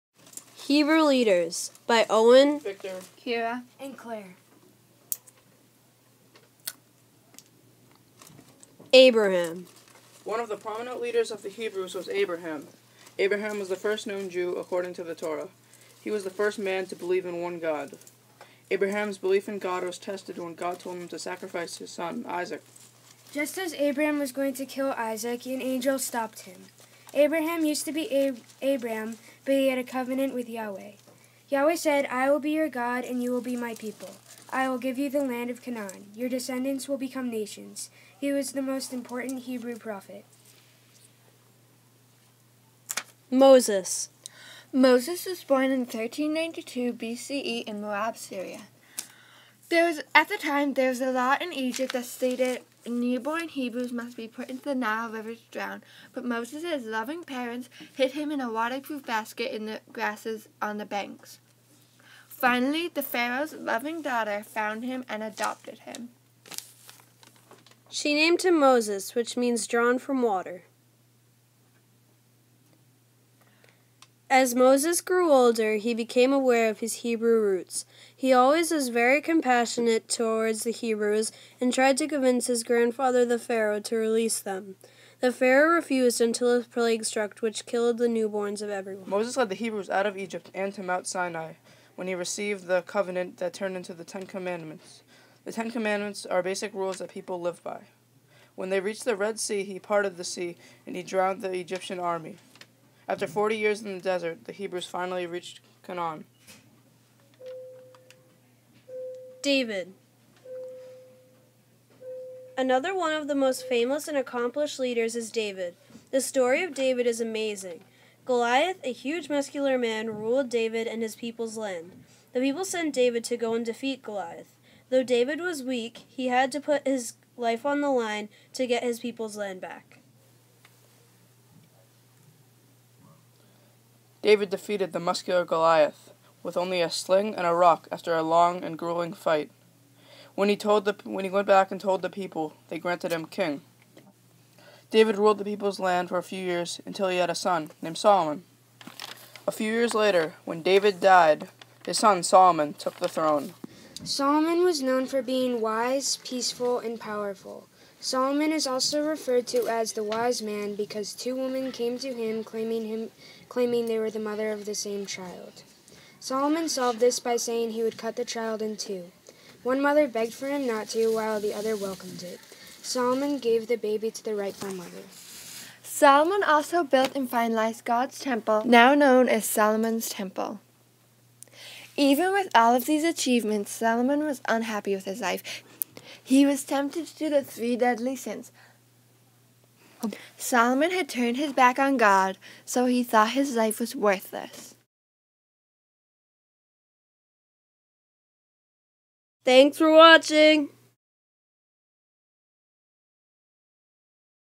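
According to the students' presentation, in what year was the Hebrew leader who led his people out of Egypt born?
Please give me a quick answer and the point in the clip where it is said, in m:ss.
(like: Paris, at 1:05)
1392 BCE, at 0:45.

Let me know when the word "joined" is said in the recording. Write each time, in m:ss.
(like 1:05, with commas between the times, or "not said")
not said.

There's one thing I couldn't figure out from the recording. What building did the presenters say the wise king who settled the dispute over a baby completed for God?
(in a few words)
Solomon's Temple.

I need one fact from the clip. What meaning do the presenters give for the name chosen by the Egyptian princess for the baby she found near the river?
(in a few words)
drawn from water.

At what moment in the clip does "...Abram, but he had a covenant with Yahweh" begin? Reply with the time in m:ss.
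0:28.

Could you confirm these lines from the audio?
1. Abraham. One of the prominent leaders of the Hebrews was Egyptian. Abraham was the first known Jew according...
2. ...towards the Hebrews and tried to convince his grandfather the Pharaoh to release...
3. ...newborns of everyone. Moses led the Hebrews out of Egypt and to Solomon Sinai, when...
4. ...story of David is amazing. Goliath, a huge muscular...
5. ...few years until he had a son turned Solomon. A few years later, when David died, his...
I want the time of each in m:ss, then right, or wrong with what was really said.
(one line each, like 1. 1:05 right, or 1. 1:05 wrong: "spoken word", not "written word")
1. 0:08 wrong: "Abraham", not "Egyptian"
2. 1:20 right
3. 1:28 wrong: "Mount", not "Solomon"
4. 1:56 right
5. 2:26 wrong: "named", not "turned".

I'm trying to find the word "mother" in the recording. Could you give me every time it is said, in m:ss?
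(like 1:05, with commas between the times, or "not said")
2:44, 2:49, 2:54.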